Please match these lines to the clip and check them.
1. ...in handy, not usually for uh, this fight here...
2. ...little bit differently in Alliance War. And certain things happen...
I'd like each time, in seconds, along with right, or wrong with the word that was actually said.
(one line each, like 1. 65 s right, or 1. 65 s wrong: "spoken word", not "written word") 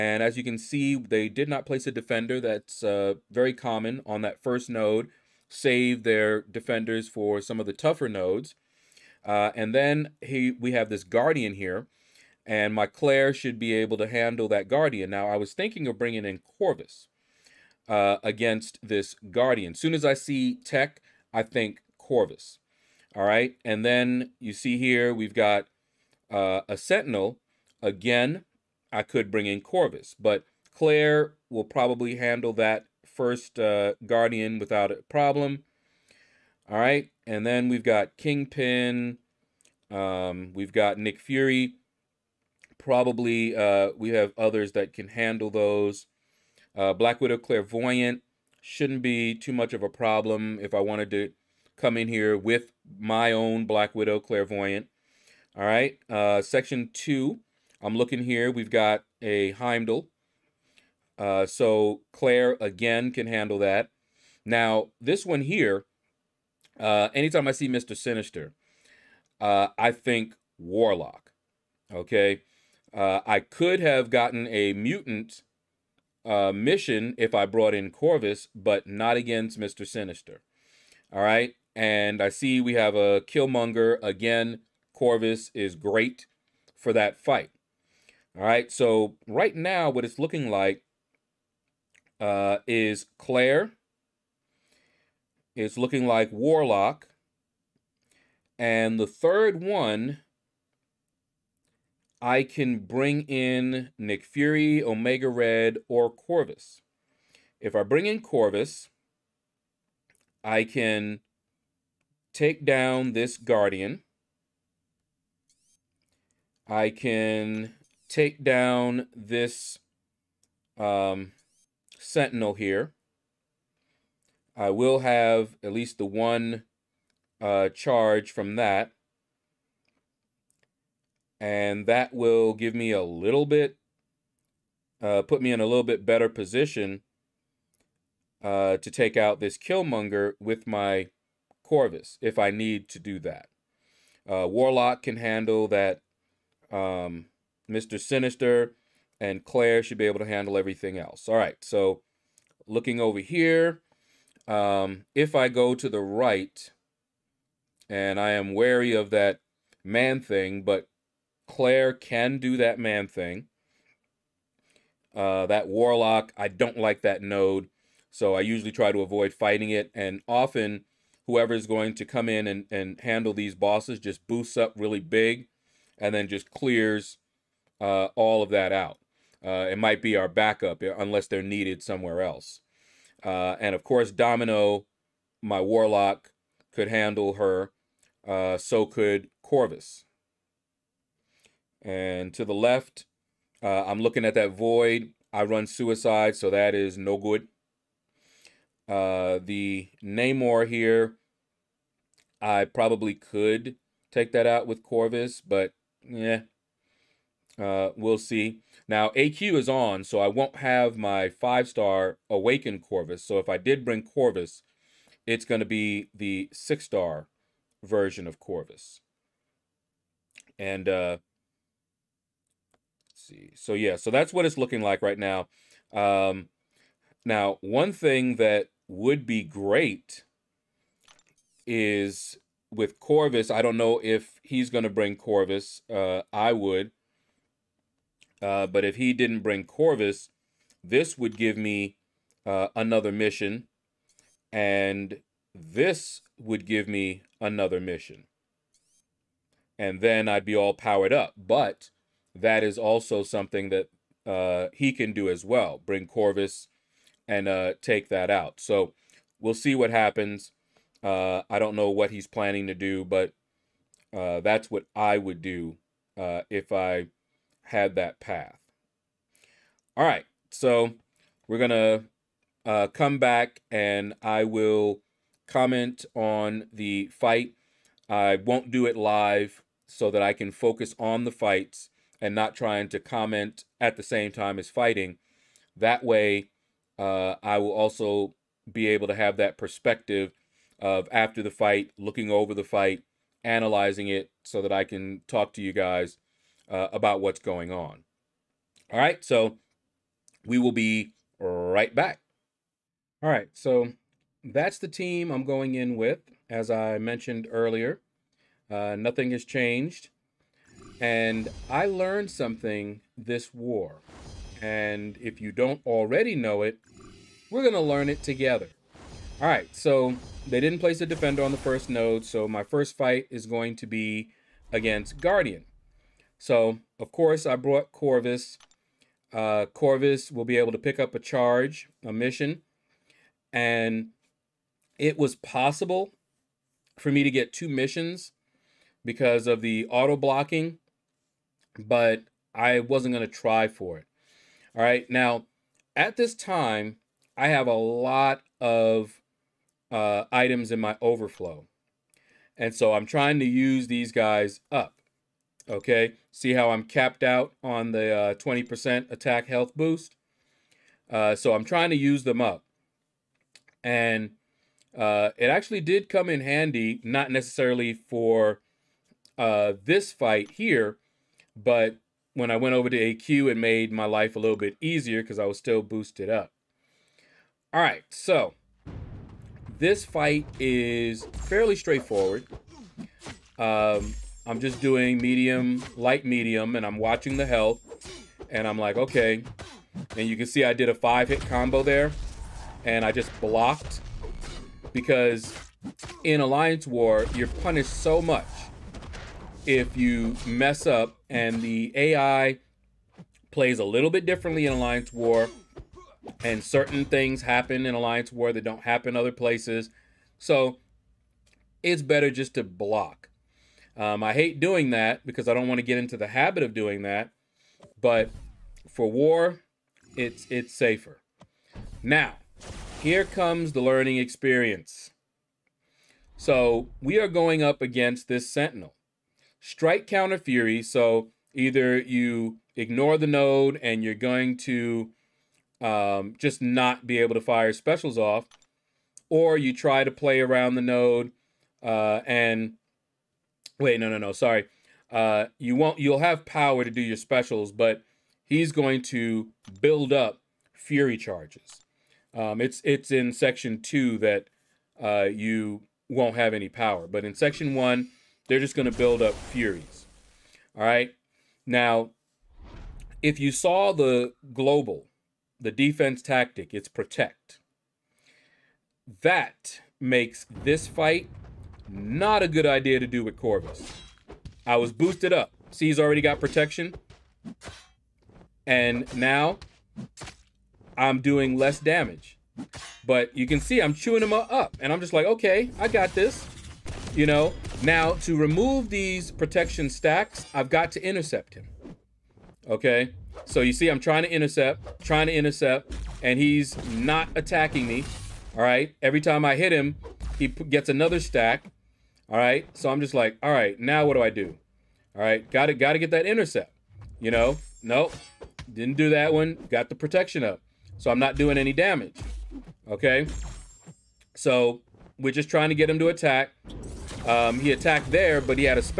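1. 366 s wrong: "necessarily", not "usually"
2. 403 s right.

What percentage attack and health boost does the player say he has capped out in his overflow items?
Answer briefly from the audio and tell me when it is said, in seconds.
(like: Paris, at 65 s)
20%, at 358 s.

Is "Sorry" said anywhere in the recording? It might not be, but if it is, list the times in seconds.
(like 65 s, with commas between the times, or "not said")
444 s.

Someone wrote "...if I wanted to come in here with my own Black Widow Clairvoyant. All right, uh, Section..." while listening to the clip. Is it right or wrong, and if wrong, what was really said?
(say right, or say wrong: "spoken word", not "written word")
right.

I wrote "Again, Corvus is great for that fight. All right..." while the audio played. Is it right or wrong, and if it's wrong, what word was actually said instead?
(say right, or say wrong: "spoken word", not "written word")
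right.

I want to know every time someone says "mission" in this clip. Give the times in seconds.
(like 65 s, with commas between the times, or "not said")
76 s, 243 s, 247 s, 332 s, 337 s.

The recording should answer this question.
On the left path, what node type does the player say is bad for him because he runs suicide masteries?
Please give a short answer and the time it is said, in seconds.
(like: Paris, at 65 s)
void, at 194 s.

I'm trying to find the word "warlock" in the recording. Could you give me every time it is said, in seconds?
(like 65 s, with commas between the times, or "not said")
70 s, 96 s, 144 s, 165 s, 185 s.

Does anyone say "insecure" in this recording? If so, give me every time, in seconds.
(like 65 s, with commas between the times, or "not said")
not said.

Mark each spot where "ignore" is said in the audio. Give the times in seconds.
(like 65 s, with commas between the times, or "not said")
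432 s.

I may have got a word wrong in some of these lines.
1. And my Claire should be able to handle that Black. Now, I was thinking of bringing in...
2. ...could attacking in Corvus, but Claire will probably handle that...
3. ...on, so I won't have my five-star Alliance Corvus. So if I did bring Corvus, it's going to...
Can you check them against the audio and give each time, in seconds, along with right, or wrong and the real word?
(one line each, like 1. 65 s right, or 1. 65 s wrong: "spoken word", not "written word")
1. 12 s wrong: "Guardian", not "Black"
2. 29 s wrong: "bring", not "attacking"
3. 209 s wrong: "Awakened", not "Alliance".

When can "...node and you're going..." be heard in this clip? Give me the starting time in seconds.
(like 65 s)
433 s.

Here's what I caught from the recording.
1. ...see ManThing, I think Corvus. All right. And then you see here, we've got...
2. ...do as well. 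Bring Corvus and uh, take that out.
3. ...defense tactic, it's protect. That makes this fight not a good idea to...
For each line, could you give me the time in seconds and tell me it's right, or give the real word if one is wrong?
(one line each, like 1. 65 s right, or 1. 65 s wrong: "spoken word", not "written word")
1. 20 s wrong: "Tech", not "ManThing"
2. 255 s right
3. 465 s right.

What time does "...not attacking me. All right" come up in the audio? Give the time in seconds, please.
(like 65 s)
496 s.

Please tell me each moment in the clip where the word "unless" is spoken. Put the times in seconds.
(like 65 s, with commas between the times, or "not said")
180 s.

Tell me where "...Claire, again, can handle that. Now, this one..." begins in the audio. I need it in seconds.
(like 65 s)
62 s.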